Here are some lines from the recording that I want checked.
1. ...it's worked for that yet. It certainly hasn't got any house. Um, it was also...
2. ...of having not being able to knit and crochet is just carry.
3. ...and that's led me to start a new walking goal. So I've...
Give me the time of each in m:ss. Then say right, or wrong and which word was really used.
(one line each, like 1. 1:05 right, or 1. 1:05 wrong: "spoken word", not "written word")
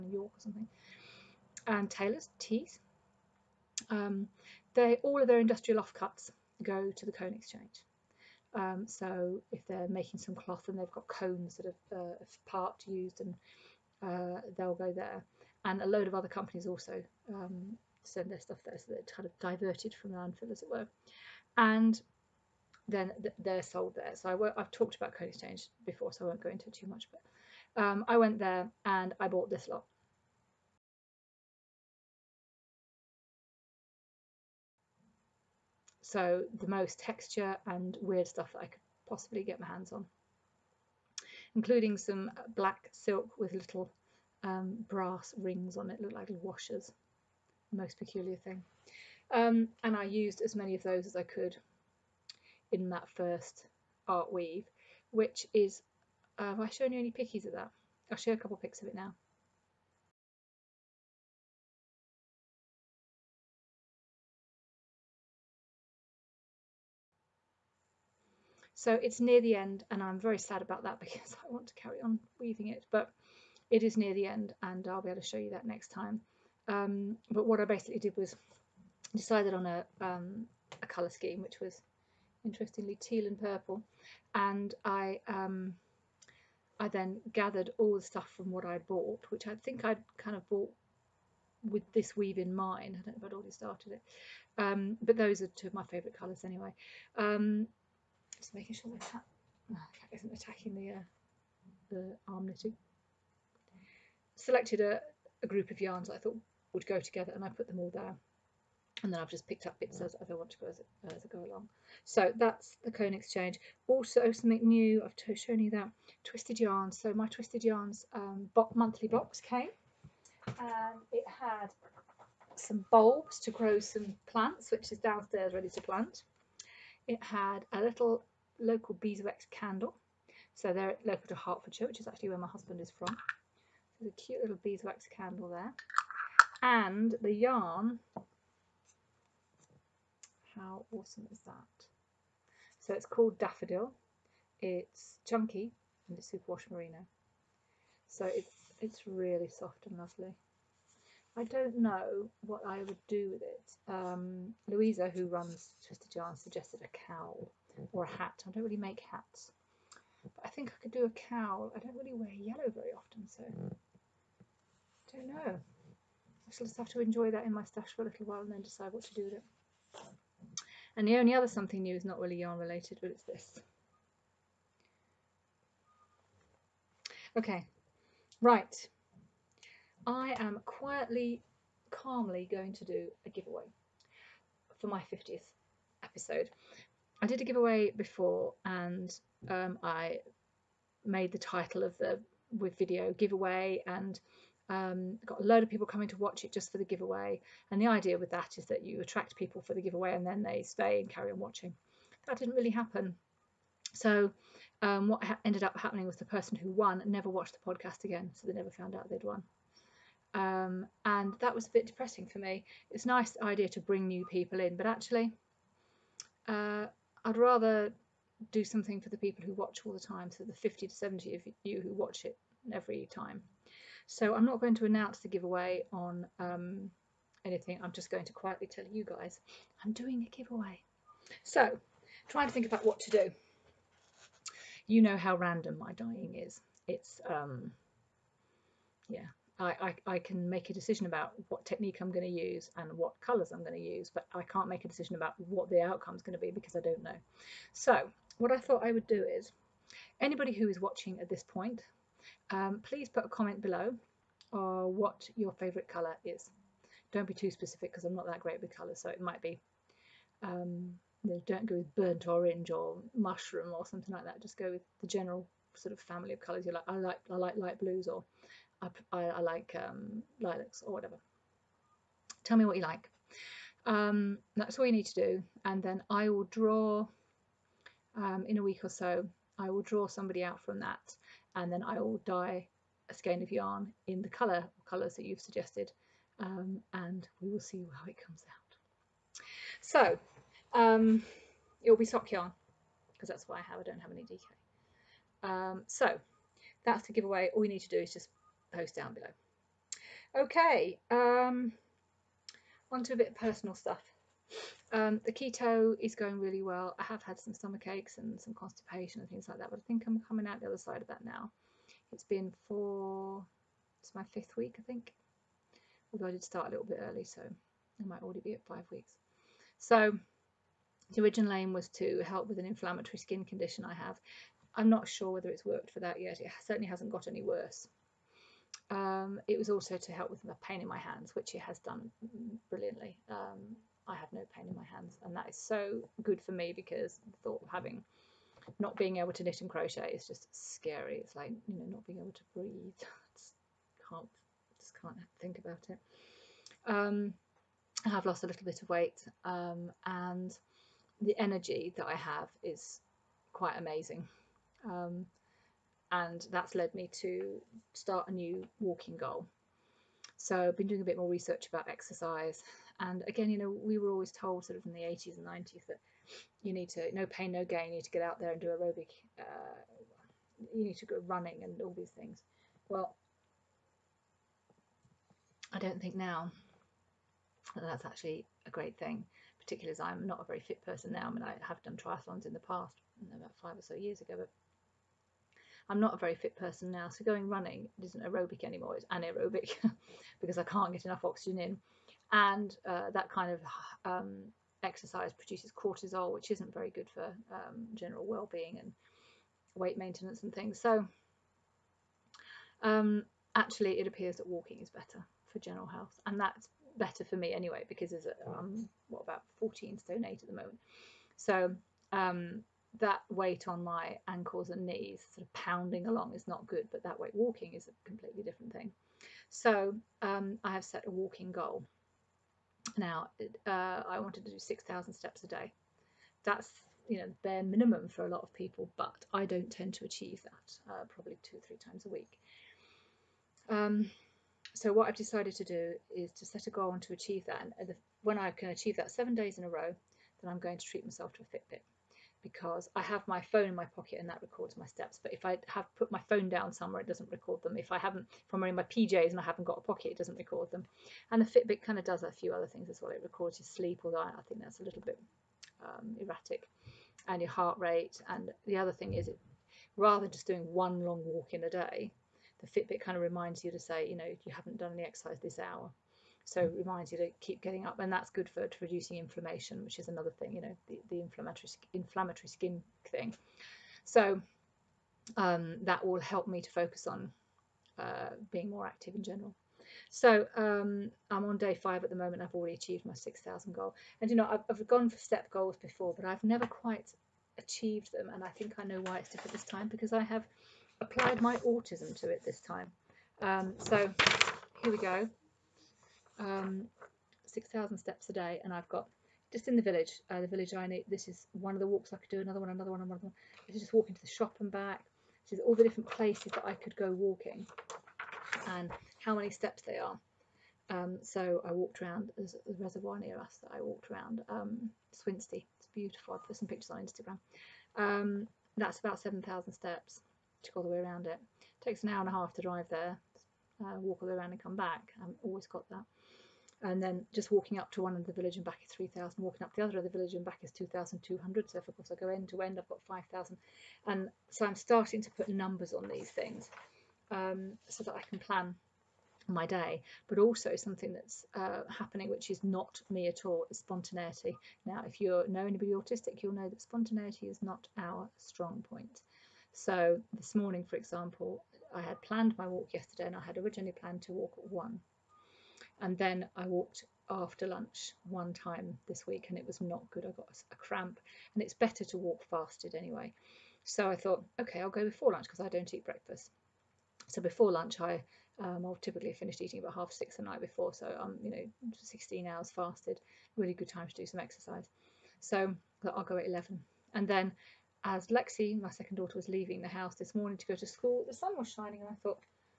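1. 5:25 wrong: "worse", not "house"
2. 5:37 wrong: "scary", not "carry"
3. 5:56 right.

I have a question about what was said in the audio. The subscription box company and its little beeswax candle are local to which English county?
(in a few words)
Hertfordshire.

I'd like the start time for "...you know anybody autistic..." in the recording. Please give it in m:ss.
9:05.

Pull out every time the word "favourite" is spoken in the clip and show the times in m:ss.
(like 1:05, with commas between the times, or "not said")
1:35, 4:15.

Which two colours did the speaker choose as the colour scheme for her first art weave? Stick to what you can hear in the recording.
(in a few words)
Teal and purple.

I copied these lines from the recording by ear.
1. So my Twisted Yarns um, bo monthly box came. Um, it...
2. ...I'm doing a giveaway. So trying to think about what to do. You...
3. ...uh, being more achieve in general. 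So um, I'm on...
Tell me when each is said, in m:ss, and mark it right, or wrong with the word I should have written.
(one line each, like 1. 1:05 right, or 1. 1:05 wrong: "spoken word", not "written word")
1. 1:56 right
2. 3:49 right
3. 7:57 wrong: "active", not "achieve".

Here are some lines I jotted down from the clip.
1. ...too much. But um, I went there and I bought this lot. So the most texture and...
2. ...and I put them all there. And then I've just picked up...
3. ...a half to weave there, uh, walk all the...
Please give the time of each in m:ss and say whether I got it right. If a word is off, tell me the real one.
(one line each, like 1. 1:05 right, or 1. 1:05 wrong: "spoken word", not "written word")
1. 0:26 right
2. 1:47 right
3. 8:42 wrong: "drive", not "weave".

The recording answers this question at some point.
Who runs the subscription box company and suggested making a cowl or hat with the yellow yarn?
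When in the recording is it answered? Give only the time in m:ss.
2:34.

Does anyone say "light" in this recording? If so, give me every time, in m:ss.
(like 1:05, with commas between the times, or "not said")
4:27.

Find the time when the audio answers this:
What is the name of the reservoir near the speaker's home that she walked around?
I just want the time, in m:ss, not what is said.
8:35.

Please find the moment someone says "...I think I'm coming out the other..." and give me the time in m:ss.
5:09.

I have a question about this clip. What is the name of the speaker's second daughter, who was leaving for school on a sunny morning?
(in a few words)
Lexi.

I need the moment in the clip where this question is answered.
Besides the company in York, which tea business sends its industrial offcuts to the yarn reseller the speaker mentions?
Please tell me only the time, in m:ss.
0:01.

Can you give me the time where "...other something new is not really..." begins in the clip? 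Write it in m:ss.
2:51.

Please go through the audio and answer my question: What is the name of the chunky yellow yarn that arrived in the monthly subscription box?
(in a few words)
Daffodil.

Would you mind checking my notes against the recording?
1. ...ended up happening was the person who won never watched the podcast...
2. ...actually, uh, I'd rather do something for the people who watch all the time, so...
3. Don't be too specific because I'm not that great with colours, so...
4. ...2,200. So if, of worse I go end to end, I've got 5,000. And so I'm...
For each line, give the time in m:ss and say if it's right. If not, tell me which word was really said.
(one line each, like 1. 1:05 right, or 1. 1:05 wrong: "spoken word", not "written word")
1. 3:25 right
2. 3:34 right
3. 4:17 right
4. 8:50 wrong: "course", not "worse".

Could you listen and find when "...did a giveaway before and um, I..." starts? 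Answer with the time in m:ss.
3:07.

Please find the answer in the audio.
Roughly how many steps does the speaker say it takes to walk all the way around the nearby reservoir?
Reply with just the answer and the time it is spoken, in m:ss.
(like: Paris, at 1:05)
7000, at 8:39.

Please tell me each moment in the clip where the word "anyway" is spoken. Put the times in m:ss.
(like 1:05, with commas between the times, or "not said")
1:36, 6:47, 9:22.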